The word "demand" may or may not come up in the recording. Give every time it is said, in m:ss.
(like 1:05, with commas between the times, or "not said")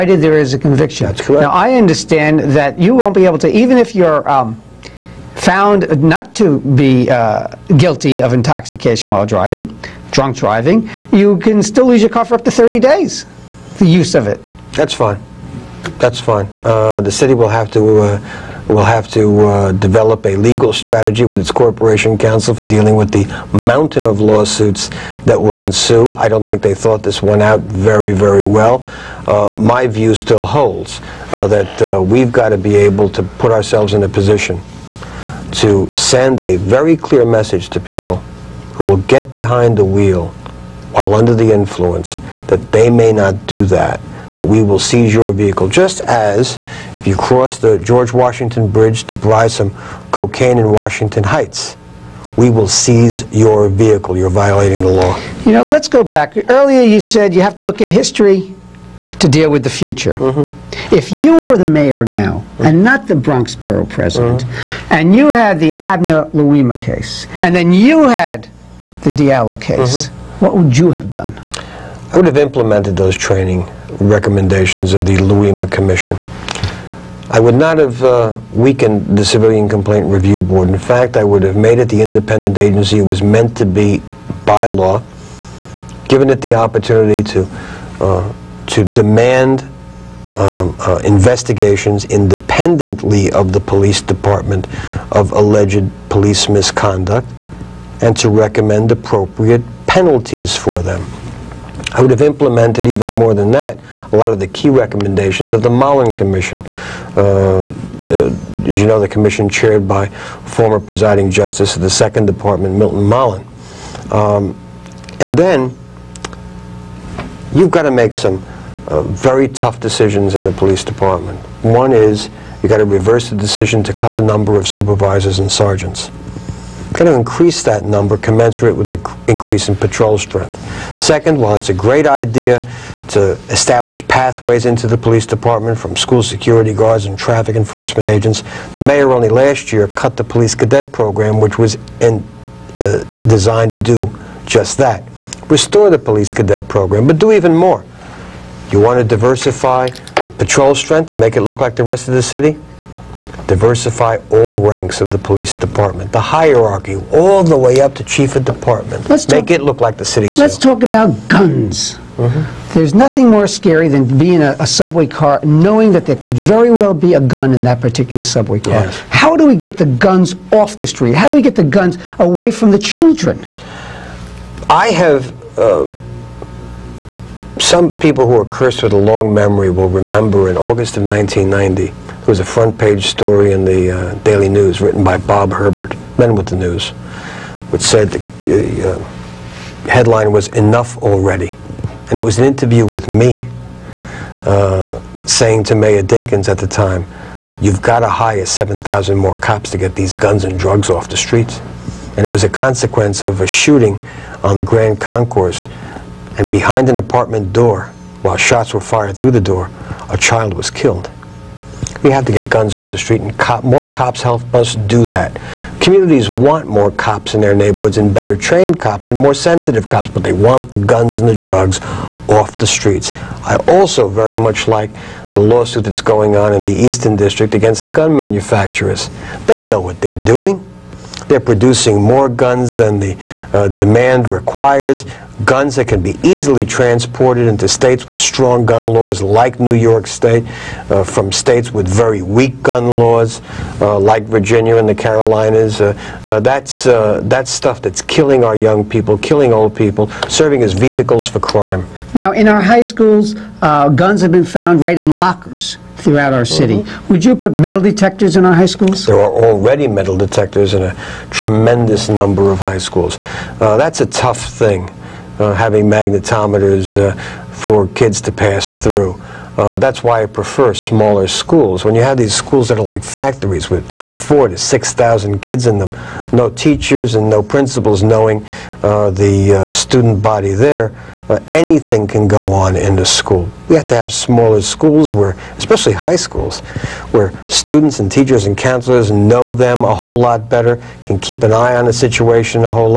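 1:28, 3:53.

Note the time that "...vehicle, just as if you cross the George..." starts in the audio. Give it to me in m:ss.
0:45.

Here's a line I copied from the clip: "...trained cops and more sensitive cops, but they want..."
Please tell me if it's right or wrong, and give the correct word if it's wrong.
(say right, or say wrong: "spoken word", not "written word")
right.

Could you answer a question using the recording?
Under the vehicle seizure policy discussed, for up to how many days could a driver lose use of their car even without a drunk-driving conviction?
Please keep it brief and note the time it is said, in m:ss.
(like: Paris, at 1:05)
30 days, at 0:12.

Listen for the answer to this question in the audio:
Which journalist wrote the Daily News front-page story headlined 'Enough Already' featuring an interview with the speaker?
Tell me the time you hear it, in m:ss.
3:05.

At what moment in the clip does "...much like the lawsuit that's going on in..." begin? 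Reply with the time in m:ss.
3:44.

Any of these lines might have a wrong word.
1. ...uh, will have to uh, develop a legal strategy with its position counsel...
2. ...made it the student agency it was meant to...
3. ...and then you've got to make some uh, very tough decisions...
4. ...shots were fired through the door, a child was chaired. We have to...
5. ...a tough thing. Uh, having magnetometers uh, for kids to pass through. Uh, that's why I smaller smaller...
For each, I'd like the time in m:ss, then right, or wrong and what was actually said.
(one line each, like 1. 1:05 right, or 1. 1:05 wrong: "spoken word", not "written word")
1. 0:17 wrong: "corporation", not "position"
2. 1:21 wrong: "independent", not "student"
3. 1:55 right
4. 3:28 wrong: "killed", not "chaired"
5. 4:24 wrong: "prefer", not "smaller".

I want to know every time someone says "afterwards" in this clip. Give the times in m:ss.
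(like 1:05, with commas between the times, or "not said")
not said.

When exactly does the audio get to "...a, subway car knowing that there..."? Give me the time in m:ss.
2:44.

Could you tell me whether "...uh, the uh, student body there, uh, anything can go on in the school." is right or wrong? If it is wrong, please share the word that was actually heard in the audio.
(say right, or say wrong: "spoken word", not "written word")
right.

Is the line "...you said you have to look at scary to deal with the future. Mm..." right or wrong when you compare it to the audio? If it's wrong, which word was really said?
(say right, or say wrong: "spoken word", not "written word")
wrong: "history", not "scary".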